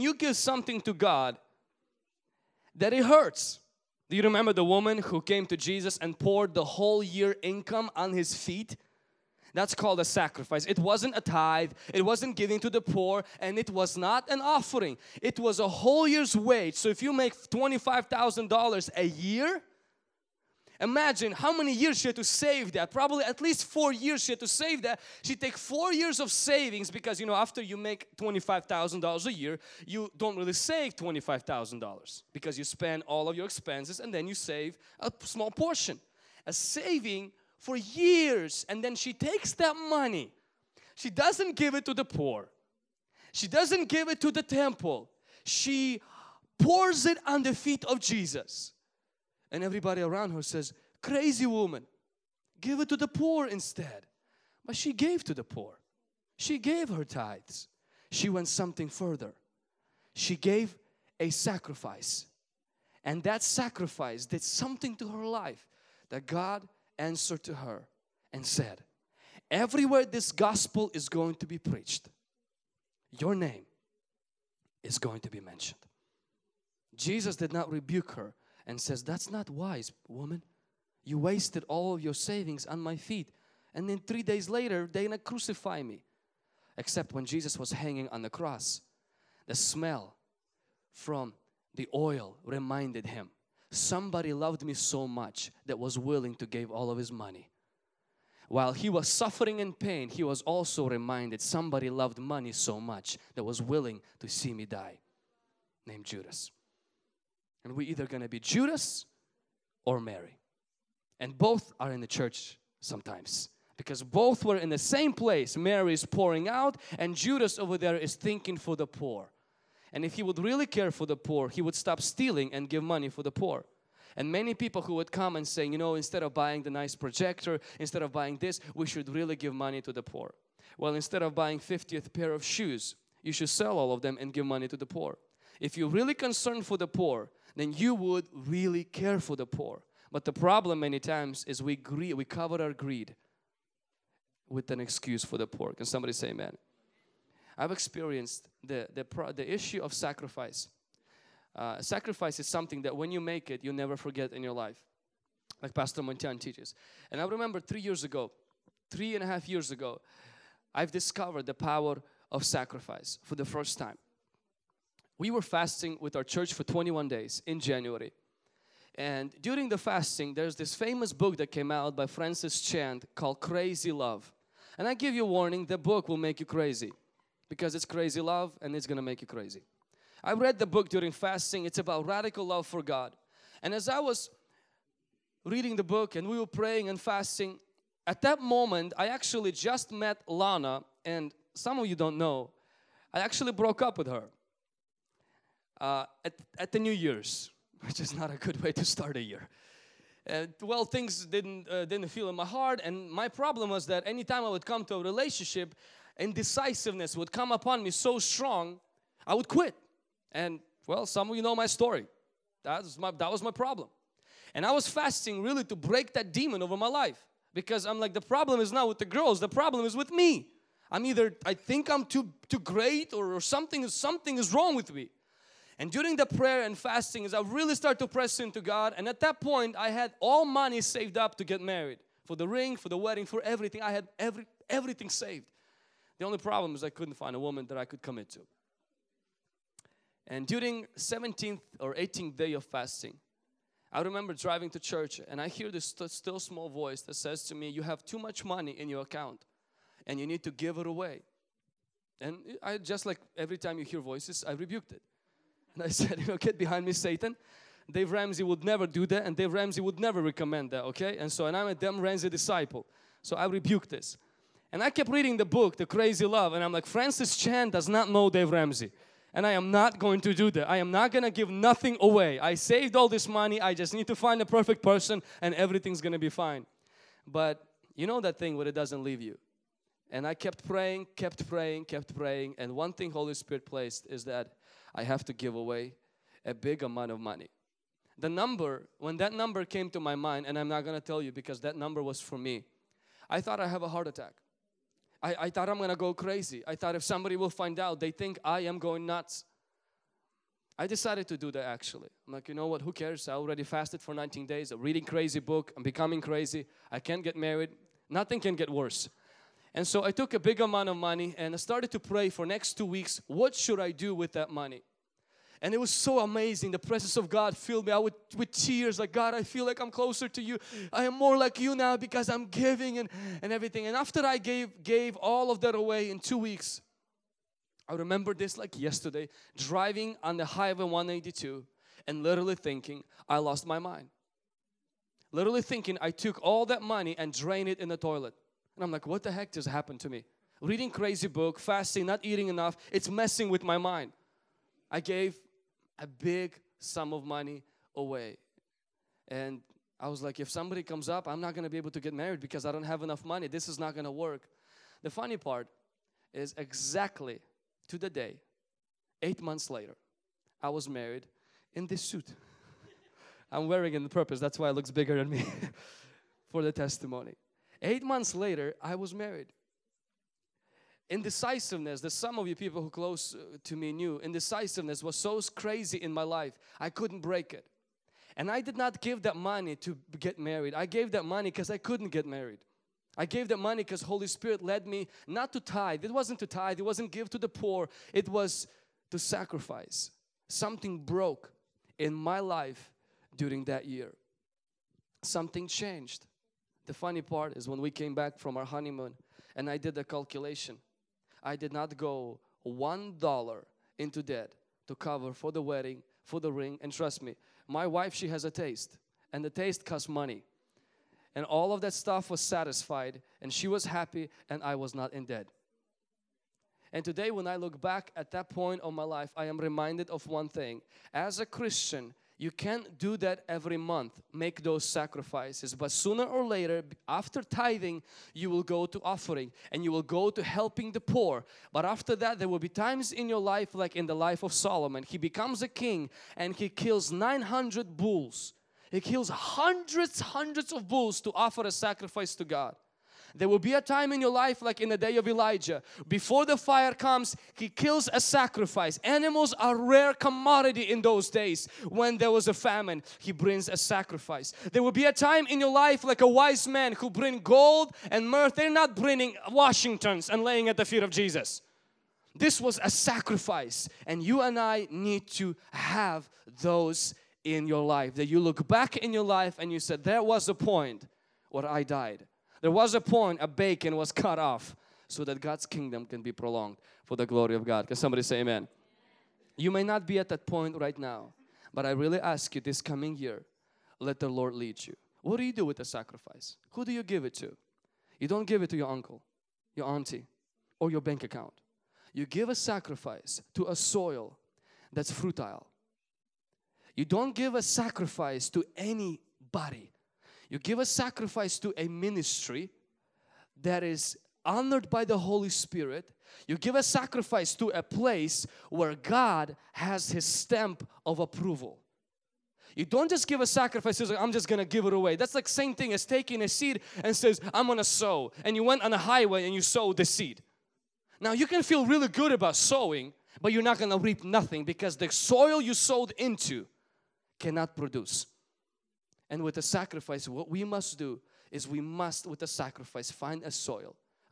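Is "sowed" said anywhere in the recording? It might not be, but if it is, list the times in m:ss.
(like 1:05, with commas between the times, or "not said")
8:39, 8:45.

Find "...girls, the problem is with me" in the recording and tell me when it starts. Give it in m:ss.
3:39.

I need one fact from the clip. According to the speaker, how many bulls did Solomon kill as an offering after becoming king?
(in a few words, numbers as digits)
900.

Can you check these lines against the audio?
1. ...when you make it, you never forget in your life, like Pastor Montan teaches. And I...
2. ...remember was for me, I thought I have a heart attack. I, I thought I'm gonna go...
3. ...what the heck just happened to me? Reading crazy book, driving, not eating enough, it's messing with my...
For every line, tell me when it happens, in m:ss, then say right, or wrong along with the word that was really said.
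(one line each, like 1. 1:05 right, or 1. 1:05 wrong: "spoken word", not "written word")
1. 2:32 right
2. 4:51 wrong: "number", not "remember"
3. 5:39 wrong: "fasting", not "driving".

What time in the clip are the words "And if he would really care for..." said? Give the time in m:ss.
1:59.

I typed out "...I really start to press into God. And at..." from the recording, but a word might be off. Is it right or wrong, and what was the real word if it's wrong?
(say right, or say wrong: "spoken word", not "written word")
right.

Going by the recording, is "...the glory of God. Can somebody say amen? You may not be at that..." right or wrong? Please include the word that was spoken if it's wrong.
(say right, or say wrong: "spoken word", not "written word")
right.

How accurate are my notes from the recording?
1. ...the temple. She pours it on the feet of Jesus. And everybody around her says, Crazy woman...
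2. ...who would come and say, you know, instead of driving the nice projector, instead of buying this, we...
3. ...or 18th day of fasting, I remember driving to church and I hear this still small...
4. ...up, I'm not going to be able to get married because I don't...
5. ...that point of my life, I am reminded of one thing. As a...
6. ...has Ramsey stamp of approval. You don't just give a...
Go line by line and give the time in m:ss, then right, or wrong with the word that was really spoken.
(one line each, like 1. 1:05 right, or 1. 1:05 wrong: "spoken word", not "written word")
1. 0:44 right
2. 2:04 wrong: "buying", not "driving"
3. 4:01 right
4. 5:51 right
5. 6:58 right
6. 8:29 wrong: "His", not "Ramsey".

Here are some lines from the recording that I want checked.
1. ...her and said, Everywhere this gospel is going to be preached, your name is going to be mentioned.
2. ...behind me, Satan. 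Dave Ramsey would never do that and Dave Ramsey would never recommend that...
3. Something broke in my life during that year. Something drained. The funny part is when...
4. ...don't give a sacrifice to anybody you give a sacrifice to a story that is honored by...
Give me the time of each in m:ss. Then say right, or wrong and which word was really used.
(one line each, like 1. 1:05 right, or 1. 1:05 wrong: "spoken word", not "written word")
1. 1:07 right
2. 4:16 right
3. 6:30 wrong: "changed", not "drained"
4. 8:17 wrong: "ministry", not "story".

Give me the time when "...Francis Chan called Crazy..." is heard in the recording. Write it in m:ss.
2:52.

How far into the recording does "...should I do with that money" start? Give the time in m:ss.
5:13.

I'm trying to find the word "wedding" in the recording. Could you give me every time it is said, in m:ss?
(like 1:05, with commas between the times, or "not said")
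3:52, 6:45.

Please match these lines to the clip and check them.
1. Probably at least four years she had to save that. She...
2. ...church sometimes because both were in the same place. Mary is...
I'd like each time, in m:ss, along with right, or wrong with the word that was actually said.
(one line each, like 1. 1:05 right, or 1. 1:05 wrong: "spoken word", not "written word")
1. 0:22 right
2. 1:52 right.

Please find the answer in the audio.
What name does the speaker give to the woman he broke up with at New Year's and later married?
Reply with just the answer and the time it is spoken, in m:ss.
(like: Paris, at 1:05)
Lana, at 3:10.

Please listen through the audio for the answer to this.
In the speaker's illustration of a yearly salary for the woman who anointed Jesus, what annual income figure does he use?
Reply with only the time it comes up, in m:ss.
0:17.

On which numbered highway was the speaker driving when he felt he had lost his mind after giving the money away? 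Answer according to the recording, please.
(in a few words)
182.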